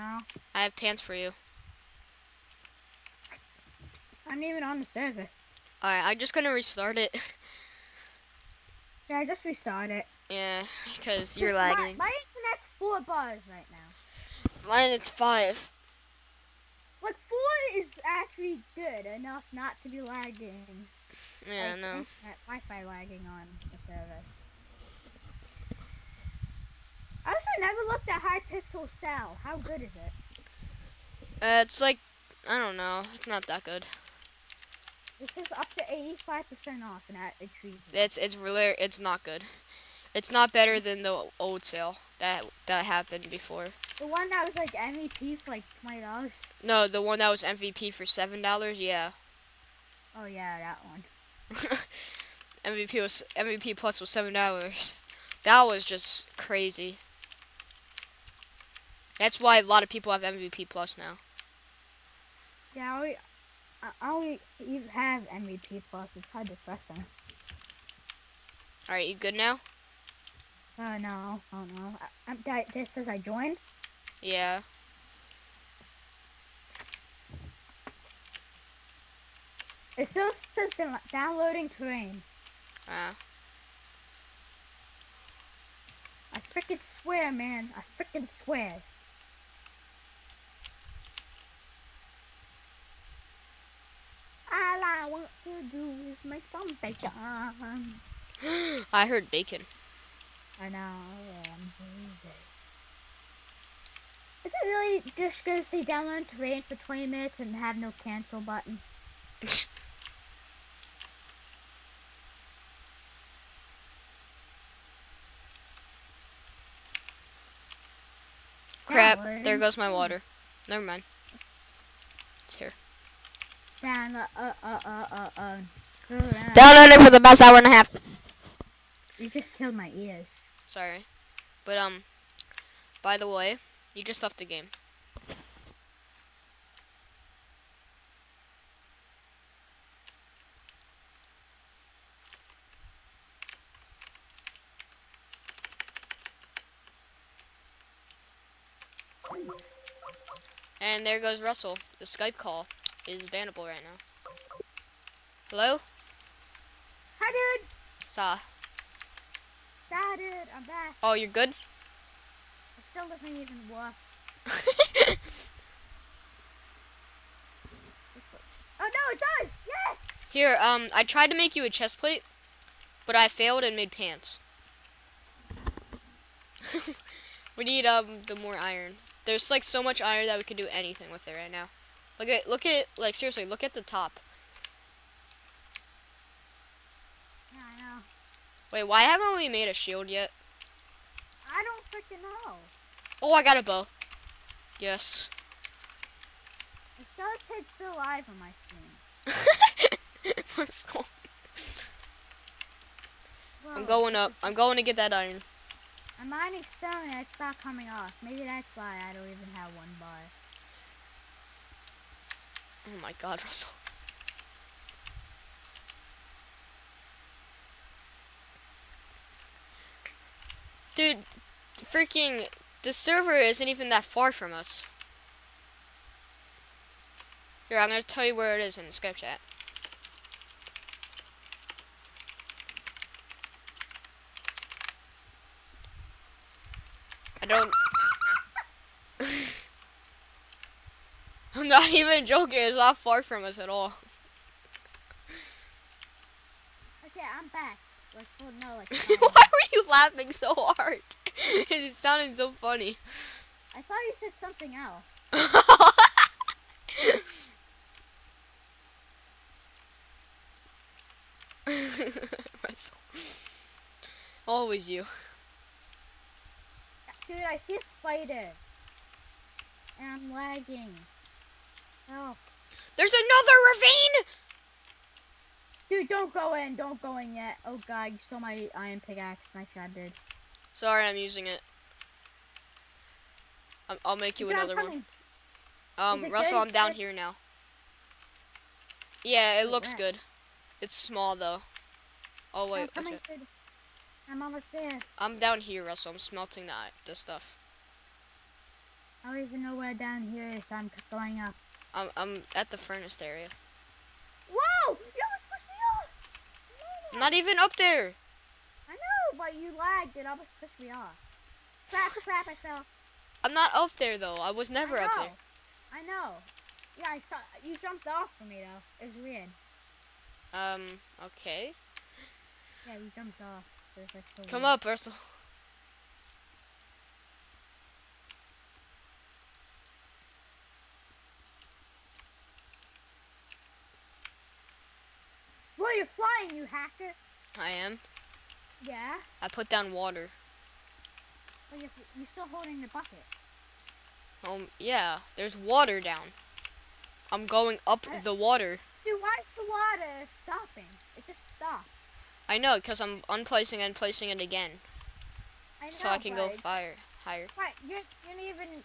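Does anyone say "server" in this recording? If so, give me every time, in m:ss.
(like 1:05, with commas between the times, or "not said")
0:04, 0:23, 3:42.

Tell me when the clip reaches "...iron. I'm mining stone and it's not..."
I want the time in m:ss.
3:25.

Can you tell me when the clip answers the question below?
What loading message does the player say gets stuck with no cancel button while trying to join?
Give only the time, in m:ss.
1:21.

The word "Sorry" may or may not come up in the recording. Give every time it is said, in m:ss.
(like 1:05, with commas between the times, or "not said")
2:10, 4:40.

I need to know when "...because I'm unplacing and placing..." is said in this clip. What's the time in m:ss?
5:52.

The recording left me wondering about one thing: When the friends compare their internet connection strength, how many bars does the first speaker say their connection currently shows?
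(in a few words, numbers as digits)
4.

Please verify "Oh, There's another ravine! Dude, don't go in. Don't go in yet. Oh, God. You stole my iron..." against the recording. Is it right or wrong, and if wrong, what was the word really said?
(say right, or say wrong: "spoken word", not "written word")
right.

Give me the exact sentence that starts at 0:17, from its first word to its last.
Like four is actually good enough not to be lagging.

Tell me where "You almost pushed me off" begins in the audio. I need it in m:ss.
5:04.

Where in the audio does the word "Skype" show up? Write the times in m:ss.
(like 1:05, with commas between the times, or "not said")
2:32, 3:48.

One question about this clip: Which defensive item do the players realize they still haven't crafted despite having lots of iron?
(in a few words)
A shield.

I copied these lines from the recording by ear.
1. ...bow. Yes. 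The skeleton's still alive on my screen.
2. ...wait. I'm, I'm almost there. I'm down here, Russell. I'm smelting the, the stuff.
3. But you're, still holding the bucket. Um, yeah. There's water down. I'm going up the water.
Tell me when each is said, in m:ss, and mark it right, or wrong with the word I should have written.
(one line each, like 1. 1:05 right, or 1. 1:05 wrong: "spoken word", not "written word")
1. 3:13 right
2. 4:52 right
3. 5:41 right.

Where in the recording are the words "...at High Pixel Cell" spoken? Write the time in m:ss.
0:28.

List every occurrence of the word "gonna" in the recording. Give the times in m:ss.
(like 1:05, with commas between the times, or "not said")
0:06, 3:47.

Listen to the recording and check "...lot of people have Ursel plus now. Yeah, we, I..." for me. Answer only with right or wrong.
wrong.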